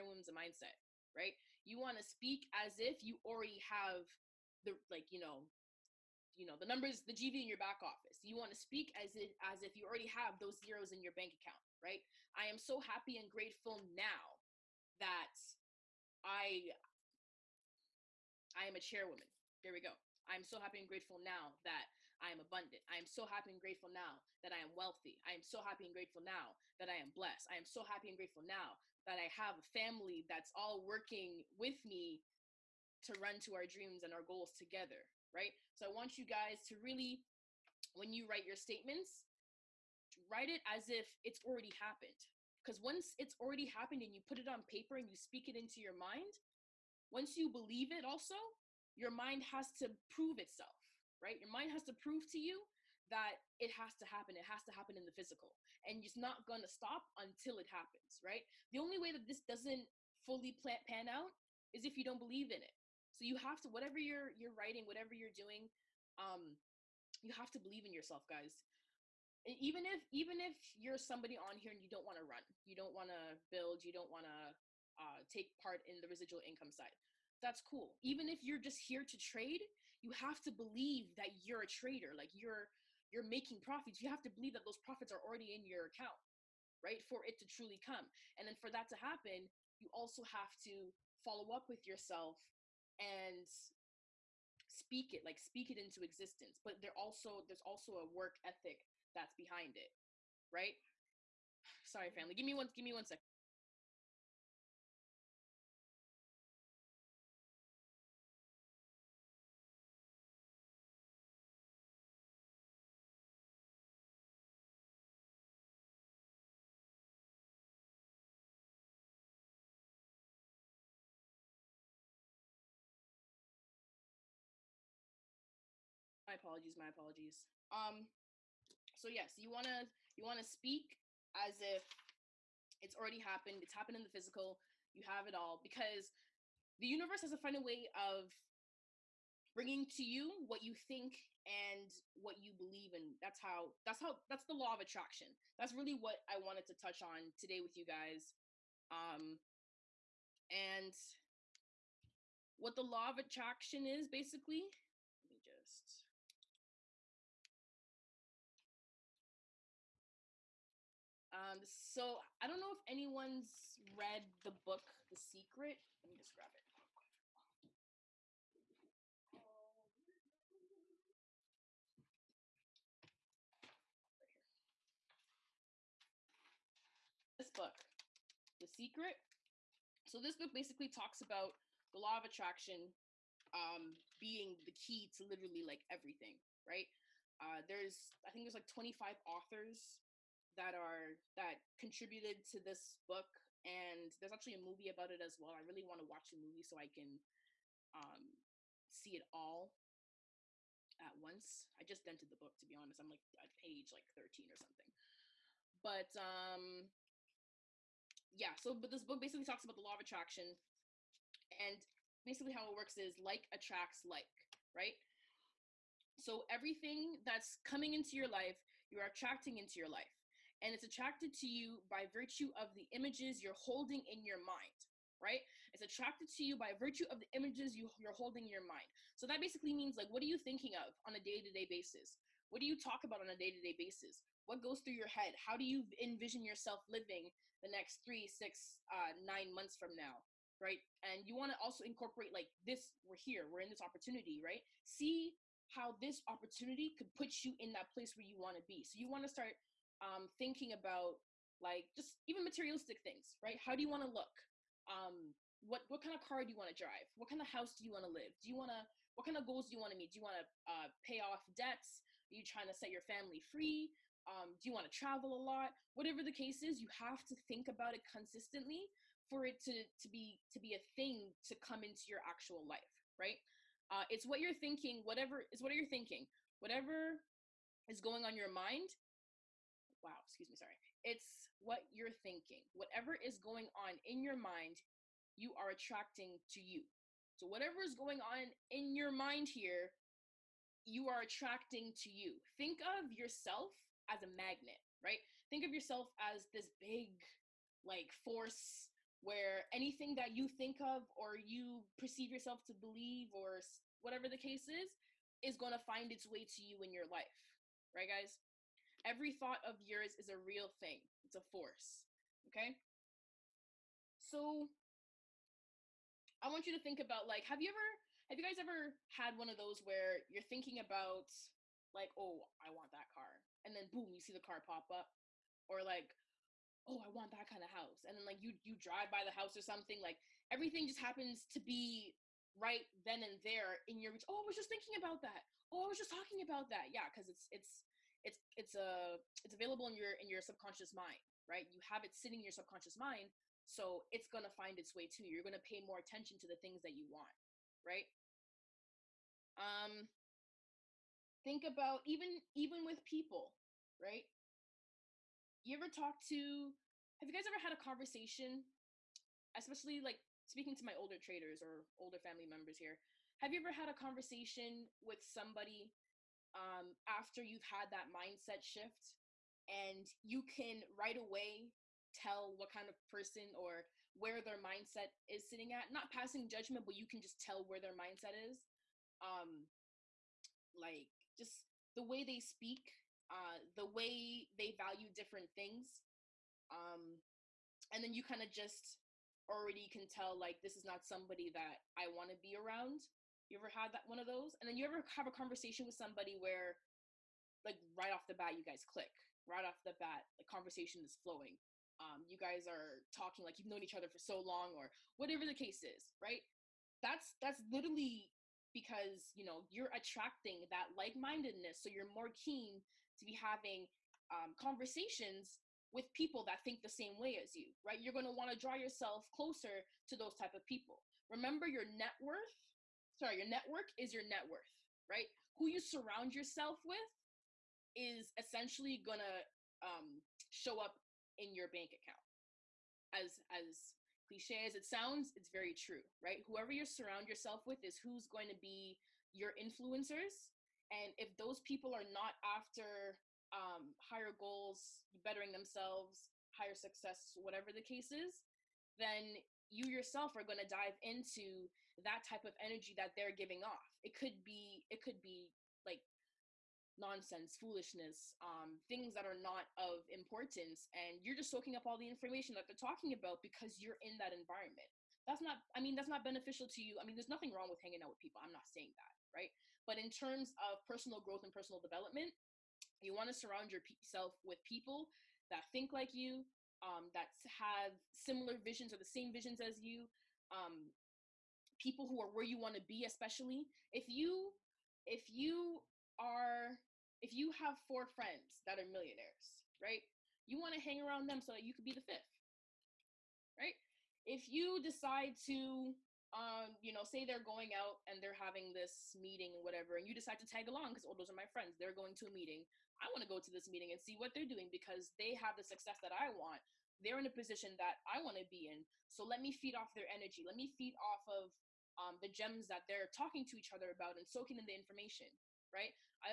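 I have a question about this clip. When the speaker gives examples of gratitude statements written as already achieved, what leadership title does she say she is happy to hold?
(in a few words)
chairwoman.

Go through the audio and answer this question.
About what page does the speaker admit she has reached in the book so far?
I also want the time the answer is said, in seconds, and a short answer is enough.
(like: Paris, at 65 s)
13, at 203 s.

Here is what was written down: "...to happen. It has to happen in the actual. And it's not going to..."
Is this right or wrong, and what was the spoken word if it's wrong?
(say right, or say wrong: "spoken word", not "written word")
wrong: "physical", not "actual".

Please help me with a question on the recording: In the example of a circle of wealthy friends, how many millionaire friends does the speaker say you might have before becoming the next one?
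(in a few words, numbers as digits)
4.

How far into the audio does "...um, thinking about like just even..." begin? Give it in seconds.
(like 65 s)
249 s.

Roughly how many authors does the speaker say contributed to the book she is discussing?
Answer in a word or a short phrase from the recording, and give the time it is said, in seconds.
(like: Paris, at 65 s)
25, at 188 s.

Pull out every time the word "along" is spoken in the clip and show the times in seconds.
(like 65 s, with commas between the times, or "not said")
500 s.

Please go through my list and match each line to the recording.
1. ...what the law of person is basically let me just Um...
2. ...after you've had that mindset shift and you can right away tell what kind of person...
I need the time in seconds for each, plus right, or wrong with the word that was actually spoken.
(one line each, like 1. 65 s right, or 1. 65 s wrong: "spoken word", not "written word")
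1. 152 s wrong: "attraction", not "person"
2. 367 s right.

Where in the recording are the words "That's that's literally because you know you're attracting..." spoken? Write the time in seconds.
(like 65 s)
407 s.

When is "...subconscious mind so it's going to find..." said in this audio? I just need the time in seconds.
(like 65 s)
342 s.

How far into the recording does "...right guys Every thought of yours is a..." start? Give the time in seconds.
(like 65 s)
307 s.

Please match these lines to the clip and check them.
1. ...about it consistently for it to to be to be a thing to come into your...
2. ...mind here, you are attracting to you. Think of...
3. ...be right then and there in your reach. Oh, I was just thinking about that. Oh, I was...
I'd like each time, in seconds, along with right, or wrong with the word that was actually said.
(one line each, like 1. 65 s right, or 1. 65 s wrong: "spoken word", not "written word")
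1. 267 s right
2. 289 s right
3. 331 s right.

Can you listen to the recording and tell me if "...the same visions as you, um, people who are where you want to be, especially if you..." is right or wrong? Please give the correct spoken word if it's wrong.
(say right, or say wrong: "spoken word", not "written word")
right.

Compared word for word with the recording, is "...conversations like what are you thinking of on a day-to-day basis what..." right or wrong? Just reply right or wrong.
wrong.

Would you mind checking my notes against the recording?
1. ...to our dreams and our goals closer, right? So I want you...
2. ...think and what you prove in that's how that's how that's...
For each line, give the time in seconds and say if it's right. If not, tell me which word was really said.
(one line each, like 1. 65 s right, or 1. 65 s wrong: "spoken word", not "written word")
1. 33 s wrong: "together", not "closer"
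2. 140 s wrong: "believe", not "prove".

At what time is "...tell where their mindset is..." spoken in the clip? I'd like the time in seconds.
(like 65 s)
377 s.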